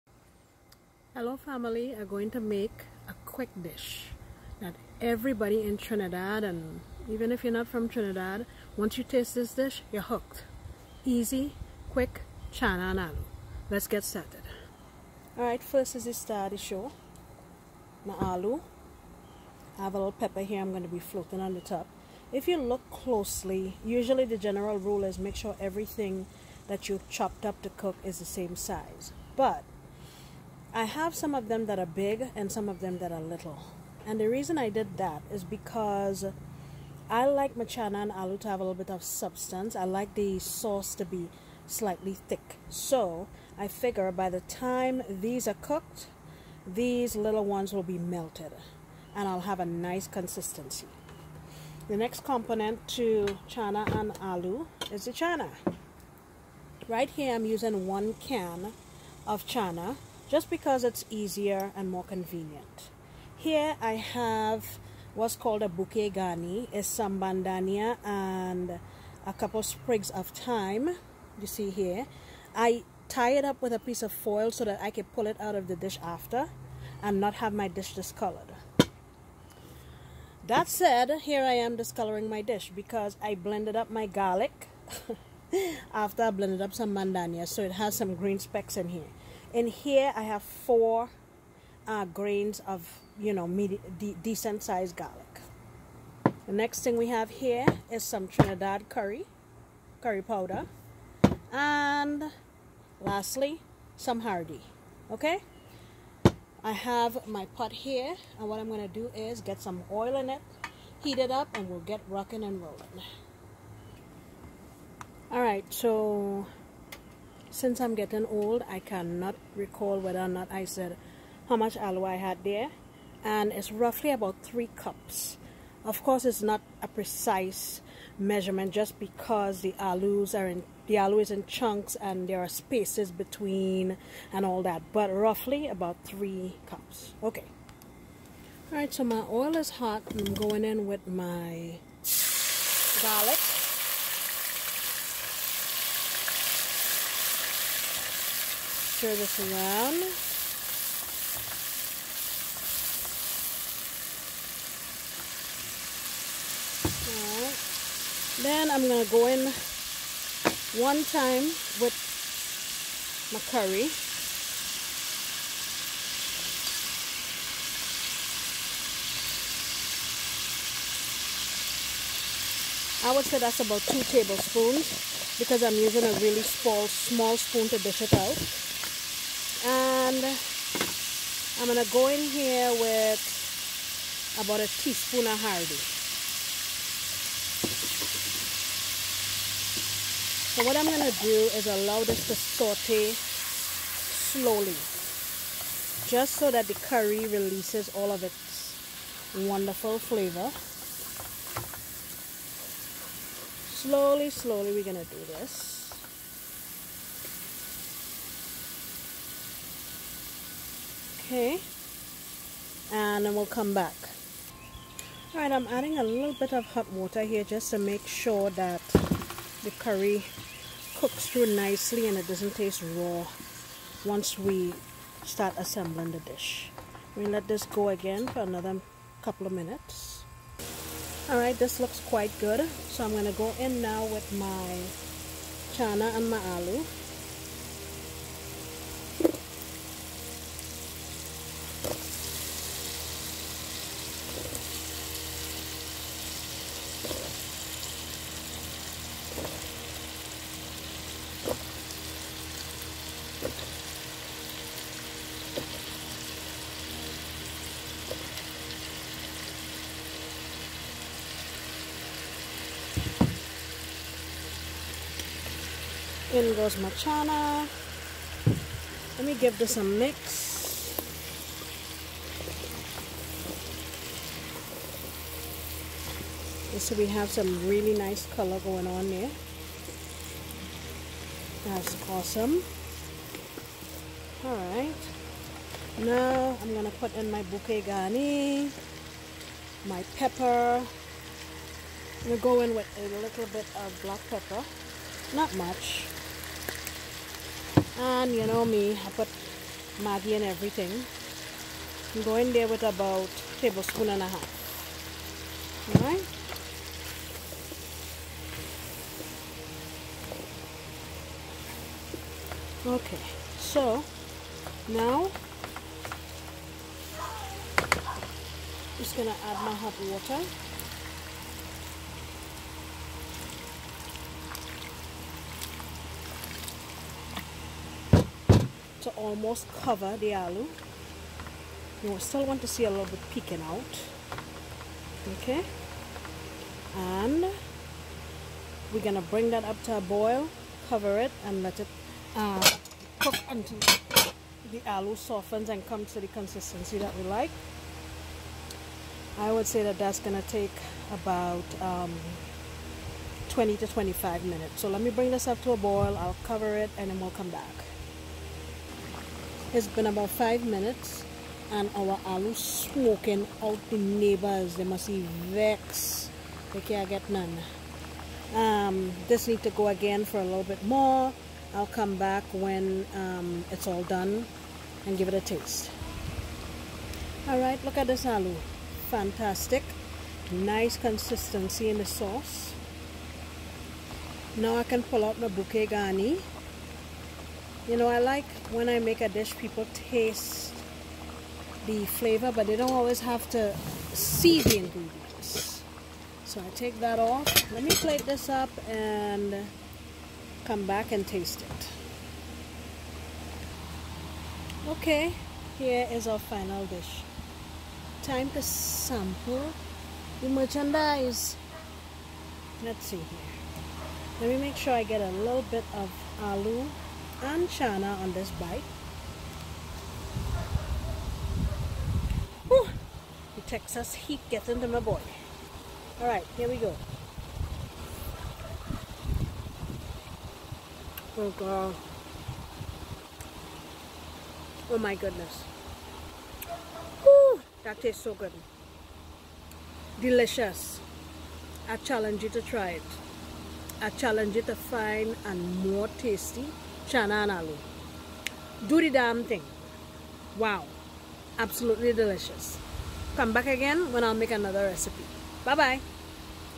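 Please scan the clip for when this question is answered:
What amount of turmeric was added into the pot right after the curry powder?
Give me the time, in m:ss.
3:04.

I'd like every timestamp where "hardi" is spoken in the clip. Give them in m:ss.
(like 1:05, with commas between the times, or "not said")
1:44, 3:05.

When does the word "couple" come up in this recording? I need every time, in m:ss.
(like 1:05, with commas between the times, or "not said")
1:09, 3:49.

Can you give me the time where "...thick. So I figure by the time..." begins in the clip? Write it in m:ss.
0:42.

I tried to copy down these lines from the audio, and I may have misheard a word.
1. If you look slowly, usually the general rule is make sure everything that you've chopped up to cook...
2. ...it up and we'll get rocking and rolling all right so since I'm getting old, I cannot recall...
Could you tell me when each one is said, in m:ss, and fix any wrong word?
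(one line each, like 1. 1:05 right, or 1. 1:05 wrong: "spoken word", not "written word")
1. 0:22 wrong: "closely", not "slowly"
2. 1:51 right.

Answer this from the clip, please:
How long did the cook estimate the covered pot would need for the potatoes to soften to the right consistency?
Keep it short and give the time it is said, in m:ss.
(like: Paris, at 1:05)
20 to 25 minutes, at 5:53.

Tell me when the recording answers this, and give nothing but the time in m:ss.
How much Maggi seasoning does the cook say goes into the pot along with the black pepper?
5:03.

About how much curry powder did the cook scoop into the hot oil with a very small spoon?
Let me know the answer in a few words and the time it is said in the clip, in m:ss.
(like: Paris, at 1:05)
2 tablespoons, at 2:53.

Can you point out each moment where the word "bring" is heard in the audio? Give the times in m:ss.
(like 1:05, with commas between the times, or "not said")
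5:39, 5:55.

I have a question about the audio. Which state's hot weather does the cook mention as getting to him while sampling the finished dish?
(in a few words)
Texas.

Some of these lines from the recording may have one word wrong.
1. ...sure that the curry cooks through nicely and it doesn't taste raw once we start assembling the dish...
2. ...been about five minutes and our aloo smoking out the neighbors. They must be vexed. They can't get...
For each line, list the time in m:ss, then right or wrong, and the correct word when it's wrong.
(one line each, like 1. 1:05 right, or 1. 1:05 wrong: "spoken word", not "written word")
1. 3:38 right
2. 5:59 right.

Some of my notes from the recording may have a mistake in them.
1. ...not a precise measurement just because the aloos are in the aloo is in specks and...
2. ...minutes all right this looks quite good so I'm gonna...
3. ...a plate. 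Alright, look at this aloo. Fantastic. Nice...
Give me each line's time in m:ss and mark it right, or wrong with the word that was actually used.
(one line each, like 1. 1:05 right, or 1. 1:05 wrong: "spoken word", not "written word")
1. 2:06 wrong: "chunks", not "specks"
2. 3:49 right
3. 6:15 wrong: "taste", not "plate".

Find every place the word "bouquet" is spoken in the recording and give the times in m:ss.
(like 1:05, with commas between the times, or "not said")
1:05, 4:47, 6:25.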